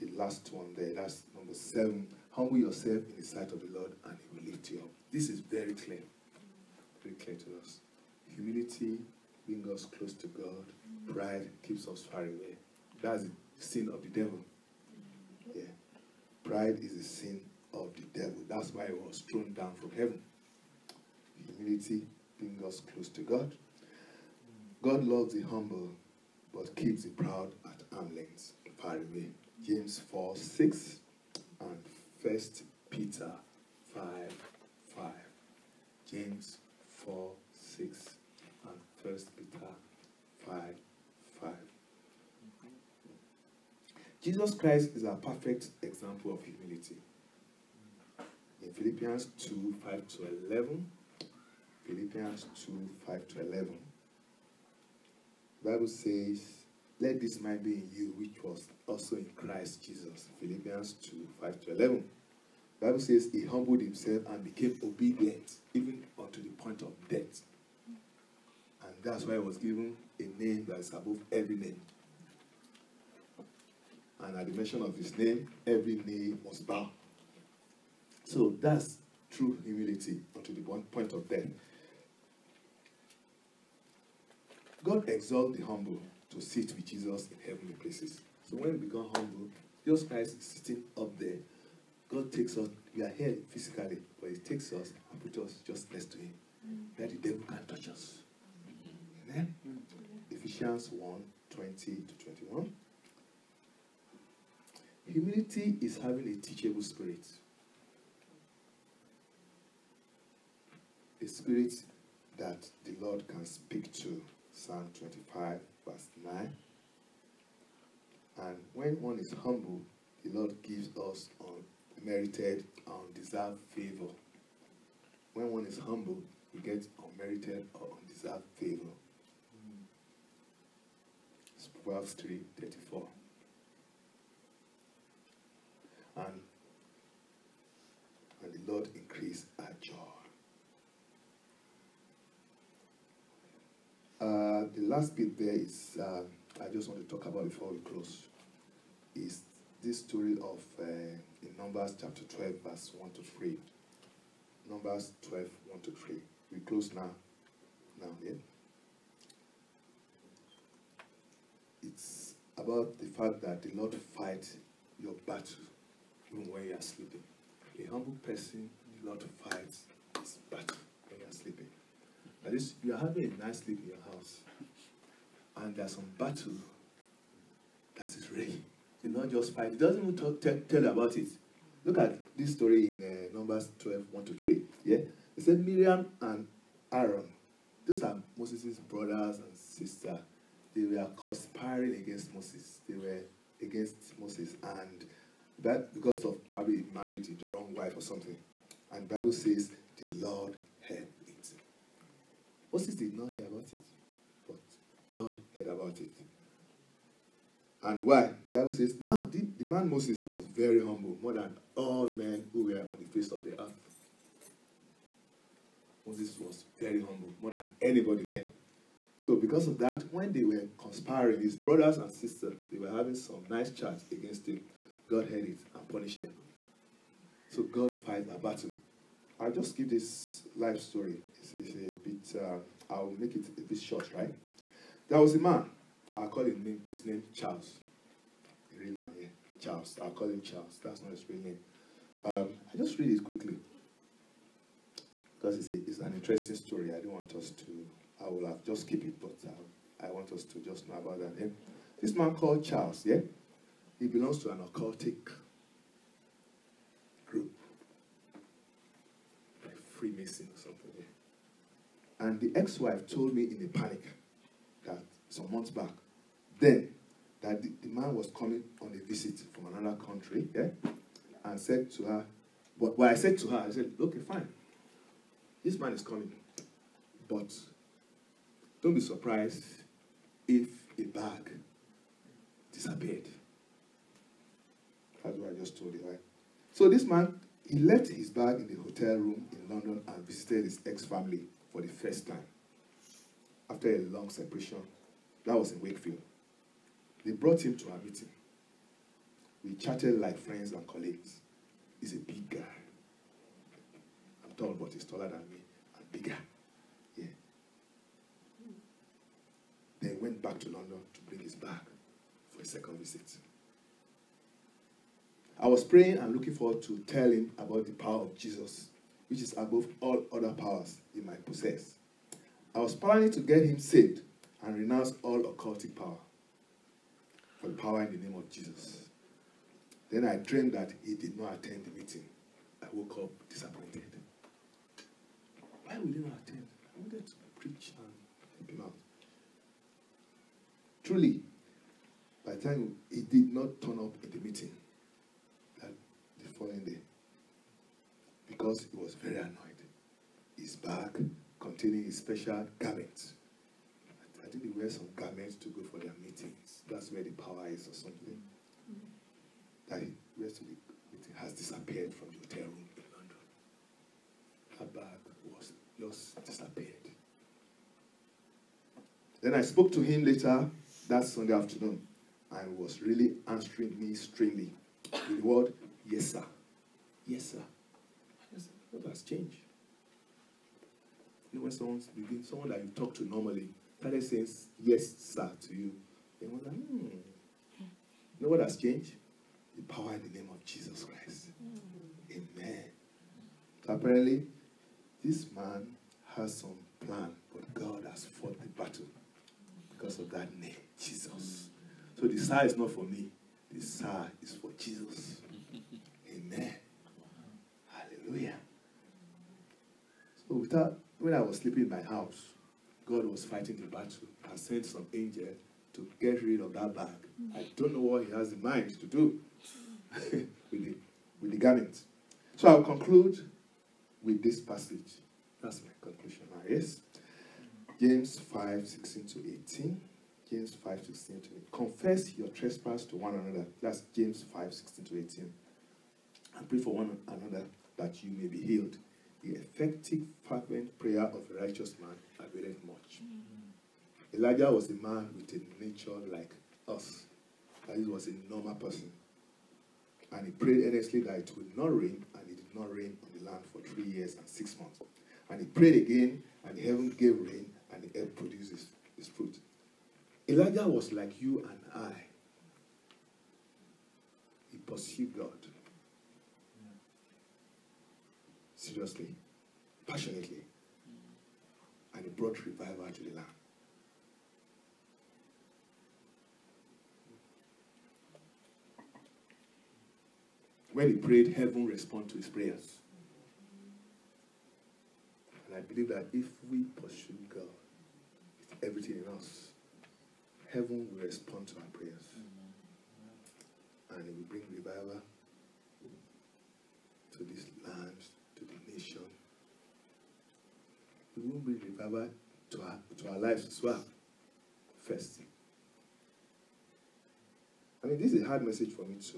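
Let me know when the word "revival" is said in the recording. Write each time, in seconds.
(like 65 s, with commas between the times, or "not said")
472 s, 494 s, 501 s.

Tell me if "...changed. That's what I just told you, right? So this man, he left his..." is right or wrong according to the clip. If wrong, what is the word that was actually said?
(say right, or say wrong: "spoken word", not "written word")
wrong: "disappeared", not "changed".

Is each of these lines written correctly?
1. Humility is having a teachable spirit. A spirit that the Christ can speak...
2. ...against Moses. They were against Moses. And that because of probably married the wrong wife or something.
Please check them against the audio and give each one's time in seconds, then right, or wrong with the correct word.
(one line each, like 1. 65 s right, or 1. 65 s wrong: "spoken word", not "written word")
1. 105 s wrong: "Lord", not "Christ"
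2. 191 s right.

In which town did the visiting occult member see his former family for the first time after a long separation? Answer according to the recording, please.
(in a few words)
Wakefield.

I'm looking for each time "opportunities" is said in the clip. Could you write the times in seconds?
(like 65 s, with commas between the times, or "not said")
not said.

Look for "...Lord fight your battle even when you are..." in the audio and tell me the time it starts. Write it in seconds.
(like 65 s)
163 s.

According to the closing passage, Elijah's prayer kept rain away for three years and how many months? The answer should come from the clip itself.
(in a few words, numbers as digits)
6.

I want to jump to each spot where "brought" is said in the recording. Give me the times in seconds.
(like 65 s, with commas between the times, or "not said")
297 s, 472 s.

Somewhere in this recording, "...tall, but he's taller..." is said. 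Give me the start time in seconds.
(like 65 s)
304 s.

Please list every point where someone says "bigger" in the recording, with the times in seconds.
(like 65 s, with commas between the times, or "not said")
306 s.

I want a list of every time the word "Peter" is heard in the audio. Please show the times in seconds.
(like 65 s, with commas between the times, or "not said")
32 s, 39 s.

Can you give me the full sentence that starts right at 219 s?
So because of that, when they were conspiring, his brothers and sisters, they were having some nice chats against him.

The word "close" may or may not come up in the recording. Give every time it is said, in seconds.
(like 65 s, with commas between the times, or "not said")
9 s, 22 s, 147 s, 156 s.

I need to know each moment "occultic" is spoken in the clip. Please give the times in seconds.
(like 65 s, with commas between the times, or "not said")
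254 s, 325 s.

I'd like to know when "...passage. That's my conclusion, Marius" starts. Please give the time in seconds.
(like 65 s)
424 s.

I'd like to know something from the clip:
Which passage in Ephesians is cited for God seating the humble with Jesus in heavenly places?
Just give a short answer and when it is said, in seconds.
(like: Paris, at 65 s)
Ephesians 1:20-21, at 100 s.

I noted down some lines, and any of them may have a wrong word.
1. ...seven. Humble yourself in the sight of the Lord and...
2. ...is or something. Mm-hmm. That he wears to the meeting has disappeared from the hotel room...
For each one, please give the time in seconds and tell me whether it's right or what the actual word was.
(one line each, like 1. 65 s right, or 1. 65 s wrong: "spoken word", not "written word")
1. 1 s right
2. 357 s right.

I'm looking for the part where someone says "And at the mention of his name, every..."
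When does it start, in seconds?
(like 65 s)
74 s.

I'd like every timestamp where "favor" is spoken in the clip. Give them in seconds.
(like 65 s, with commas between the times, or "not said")
123 s, 128 s.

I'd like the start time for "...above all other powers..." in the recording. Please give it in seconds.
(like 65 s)
319 s.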